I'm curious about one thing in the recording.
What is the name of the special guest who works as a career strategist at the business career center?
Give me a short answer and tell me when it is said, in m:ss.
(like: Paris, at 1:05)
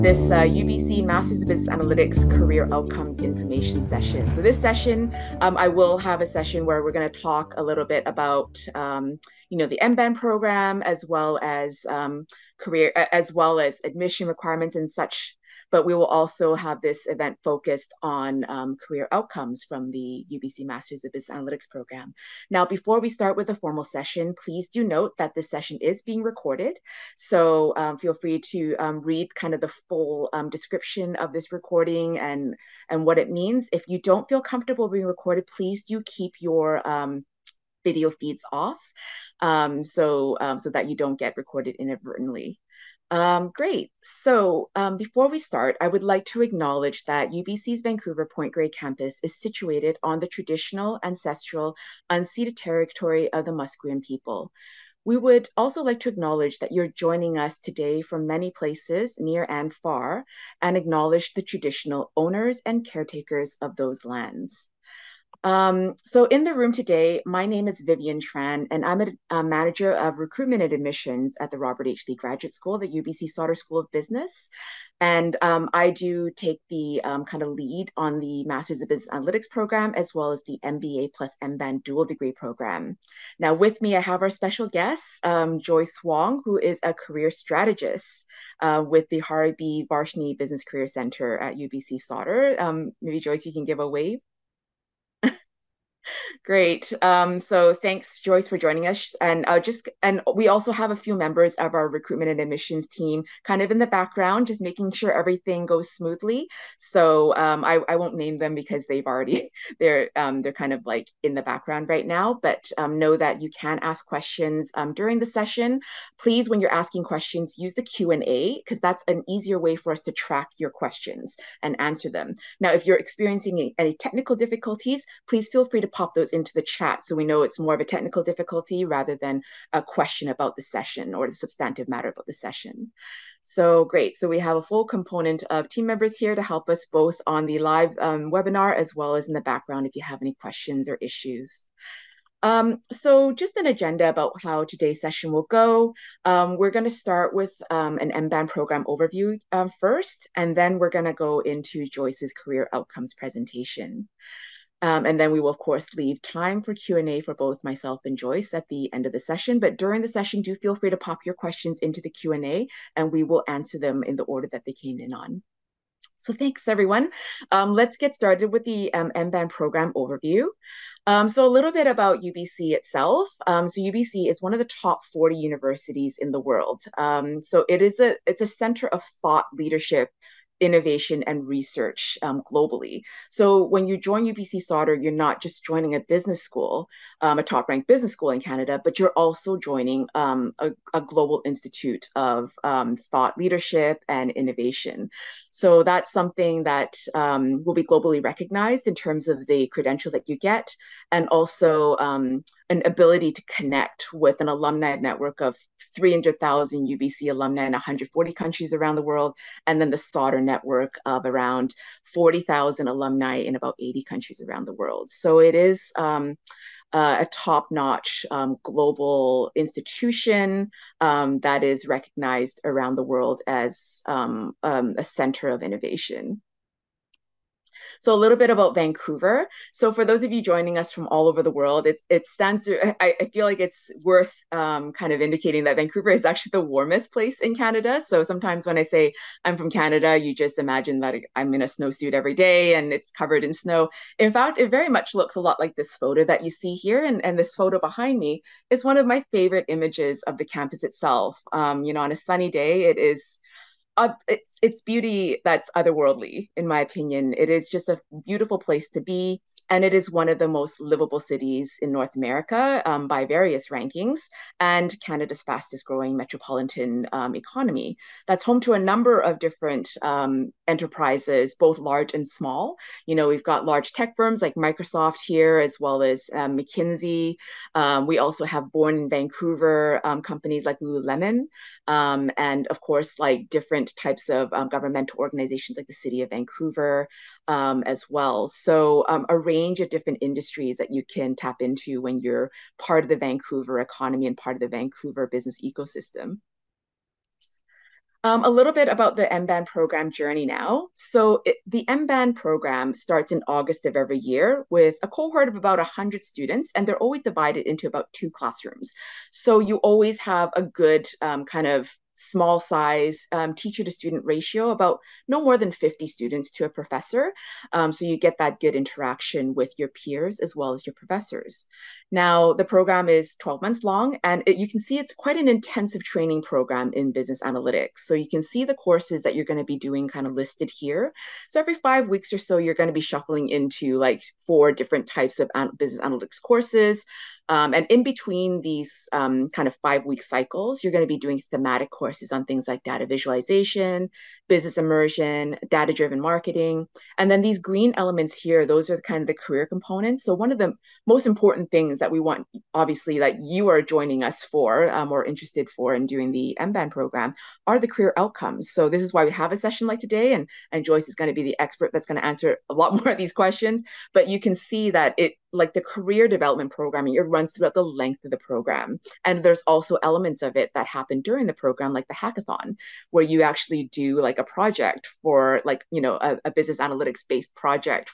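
Joyce Wong, at 1:25.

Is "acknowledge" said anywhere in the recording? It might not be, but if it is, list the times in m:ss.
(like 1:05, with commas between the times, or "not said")
0:46, 0:56, 1:00.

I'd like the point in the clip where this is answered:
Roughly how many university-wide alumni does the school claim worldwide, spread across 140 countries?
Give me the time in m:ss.
3:25.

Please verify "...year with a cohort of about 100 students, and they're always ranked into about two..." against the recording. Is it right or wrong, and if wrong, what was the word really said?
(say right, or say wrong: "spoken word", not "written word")
wrong: "divided", not "ranked".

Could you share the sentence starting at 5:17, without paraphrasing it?
Um, so you get that good interaction with your peers as well as your professors.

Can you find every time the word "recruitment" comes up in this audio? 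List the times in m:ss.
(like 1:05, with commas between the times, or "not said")
1:10, 1:41.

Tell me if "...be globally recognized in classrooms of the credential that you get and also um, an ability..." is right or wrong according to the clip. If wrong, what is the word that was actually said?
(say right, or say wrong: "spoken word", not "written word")
wrong: "terms", not "classrooms".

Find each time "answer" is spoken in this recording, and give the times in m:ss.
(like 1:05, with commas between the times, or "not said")
2:01, 2:43, 6:02.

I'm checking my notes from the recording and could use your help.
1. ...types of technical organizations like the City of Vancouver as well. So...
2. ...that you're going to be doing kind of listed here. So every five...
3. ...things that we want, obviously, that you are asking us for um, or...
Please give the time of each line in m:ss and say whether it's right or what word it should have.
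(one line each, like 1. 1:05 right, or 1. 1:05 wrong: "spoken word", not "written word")
1. 4:43 wrong: "governmental", not "technical"
2. 5:29 right
3. 5:51 wrong: "joining", not "asking".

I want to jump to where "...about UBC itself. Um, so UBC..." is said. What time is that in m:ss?
2:51.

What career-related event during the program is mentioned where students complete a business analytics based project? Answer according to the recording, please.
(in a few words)
hackathon.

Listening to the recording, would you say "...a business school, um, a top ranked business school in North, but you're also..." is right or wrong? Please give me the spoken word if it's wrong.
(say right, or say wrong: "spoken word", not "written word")
wrong: "Canada", not "North".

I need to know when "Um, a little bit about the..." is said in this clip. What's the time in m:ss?
4:58.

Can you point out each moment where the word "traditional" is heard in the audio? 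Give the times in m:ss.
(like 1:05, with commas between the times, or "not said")
0:50, 1:01.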